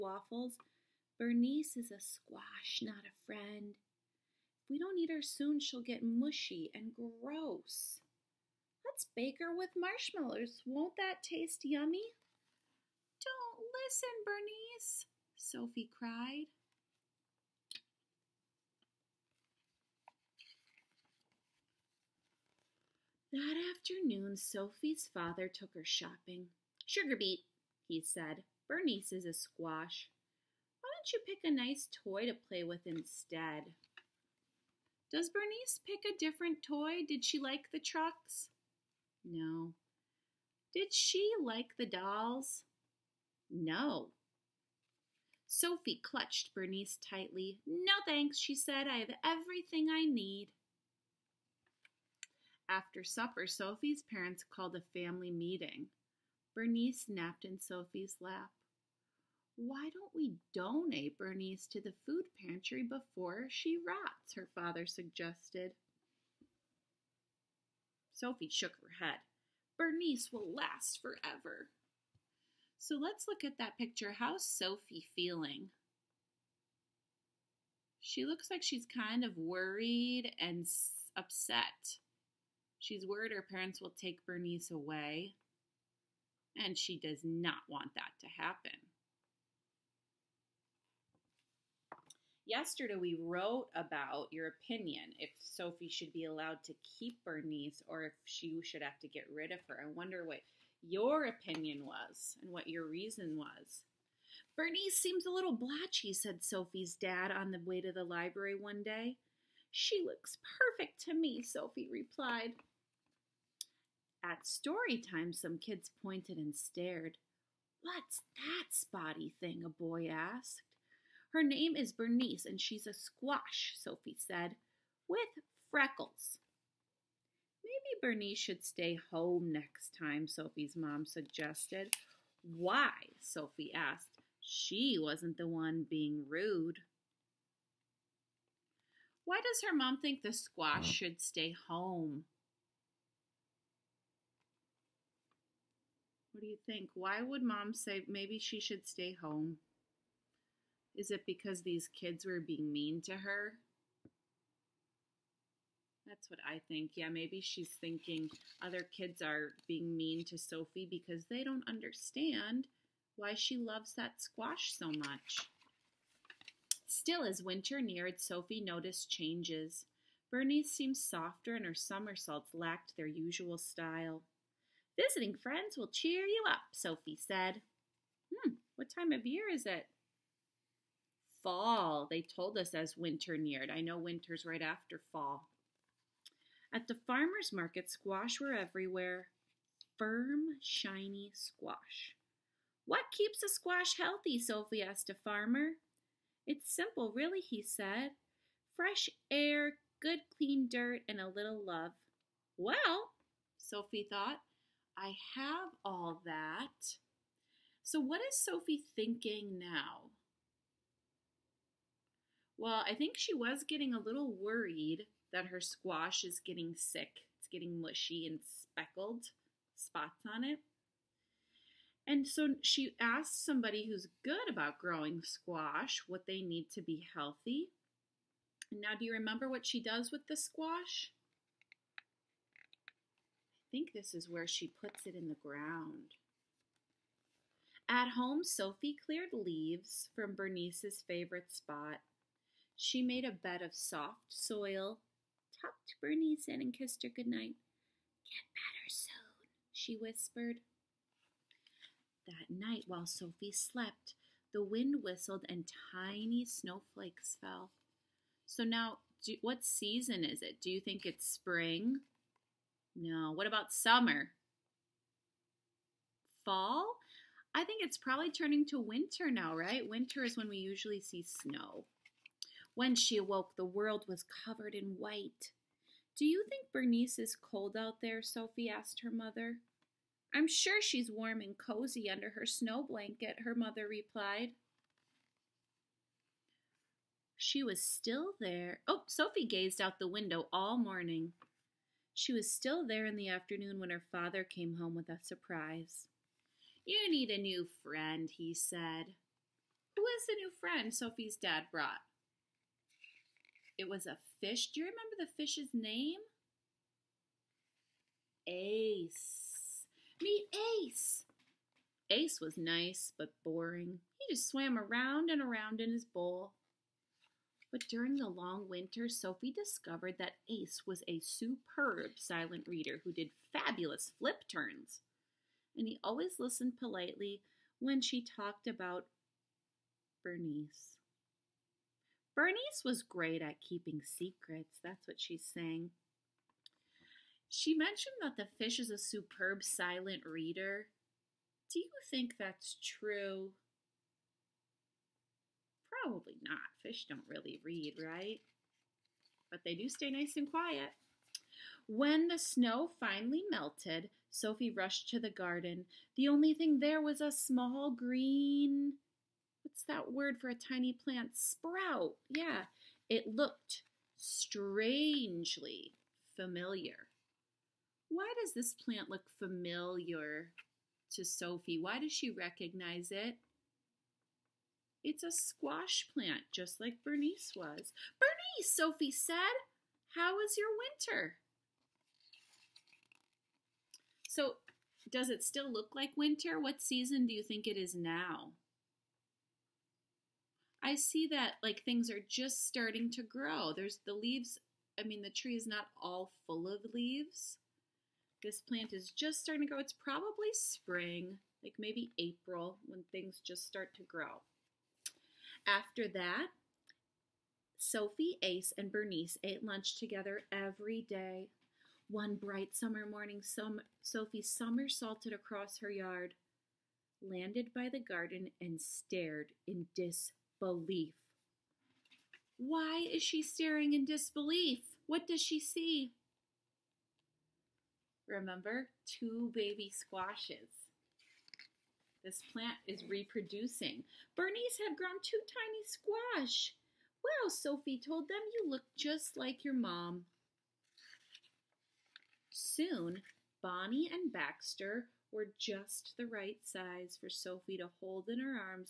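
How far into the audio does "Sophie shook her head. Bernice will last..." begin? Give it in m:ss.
1:08.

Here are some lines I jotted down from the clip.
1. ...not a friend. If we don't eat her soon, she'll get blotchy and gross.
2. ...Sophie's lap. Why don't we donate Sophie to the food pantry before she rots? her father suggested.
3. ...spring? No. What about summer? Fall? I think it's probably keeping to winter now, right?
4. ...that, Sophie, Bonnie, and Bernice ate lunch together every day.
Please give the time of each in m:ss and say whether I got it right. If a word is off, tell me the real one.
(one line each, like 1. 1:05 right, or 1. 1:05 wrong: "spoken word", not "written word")
1. 0:02 wrong: "mushy", not "blotchy"
2. 0:57 wrong: "Bernice", not "Sophie"
3. 4:21 wrong: "turning", not "keeping"
4. 6:46 wrong: "Ace", not "Bonnie".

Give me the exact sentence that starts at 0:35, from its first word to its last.
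Does Bernice pick a different toy?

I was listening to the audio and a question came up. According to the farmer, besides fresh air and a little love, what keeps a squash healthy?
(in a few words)
Good clean dirt.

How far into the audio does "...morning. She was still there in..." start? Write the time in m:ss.
4:50.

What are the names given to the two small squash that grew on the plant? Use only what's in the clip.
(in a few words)
Bonnie and Baxter.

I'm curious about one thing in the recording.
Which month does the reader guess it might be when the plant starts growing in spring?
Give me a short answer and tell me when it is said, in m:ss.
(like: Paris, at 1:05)
April, at 6:42.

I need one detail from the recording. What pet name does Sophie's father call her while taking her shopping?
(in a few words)
Sugar beet.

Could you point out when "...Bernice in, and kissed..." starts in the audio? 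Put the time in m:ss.
4:05.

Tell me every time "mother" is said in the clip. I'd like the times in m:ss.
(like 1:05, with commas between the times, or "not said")
4:39, 4:43.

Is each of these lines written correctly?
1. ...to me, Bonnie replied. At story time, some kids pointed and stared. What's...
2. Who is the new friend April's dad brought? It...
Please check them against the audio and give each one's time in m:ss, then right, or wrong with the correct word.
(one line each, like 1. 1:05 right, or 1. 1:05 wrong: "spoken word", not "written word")
1. 1:51 wrong: "Sophie", not "Bonnie"
2. 4:59 wrong: "Sophie", not "April".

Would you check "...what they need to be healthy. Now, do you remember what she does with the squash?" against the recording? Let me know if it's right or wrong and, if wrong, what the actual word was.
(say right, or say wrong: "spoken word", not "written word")
right.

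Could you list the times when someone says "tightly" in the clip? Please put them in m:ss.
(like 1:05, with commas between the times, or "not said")
0:47.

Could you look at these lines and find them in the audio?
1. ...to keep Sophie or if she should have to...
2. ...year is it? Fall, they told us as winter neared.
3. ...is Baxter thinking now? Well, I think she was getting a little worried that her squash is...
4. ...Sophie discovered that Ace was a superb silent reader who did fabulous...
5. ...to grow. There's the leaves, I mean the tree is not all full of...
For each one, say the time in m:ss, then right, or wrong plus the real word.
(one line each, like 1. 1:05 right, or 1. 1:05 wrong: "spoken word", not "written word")
1. 1:36 wrong: "Bernice", not "Sophie"
2. 2:59 right
3. 3:28 wrong: "Sophie", not "Baxter"
4. 5:19 right
5. 6:33 right.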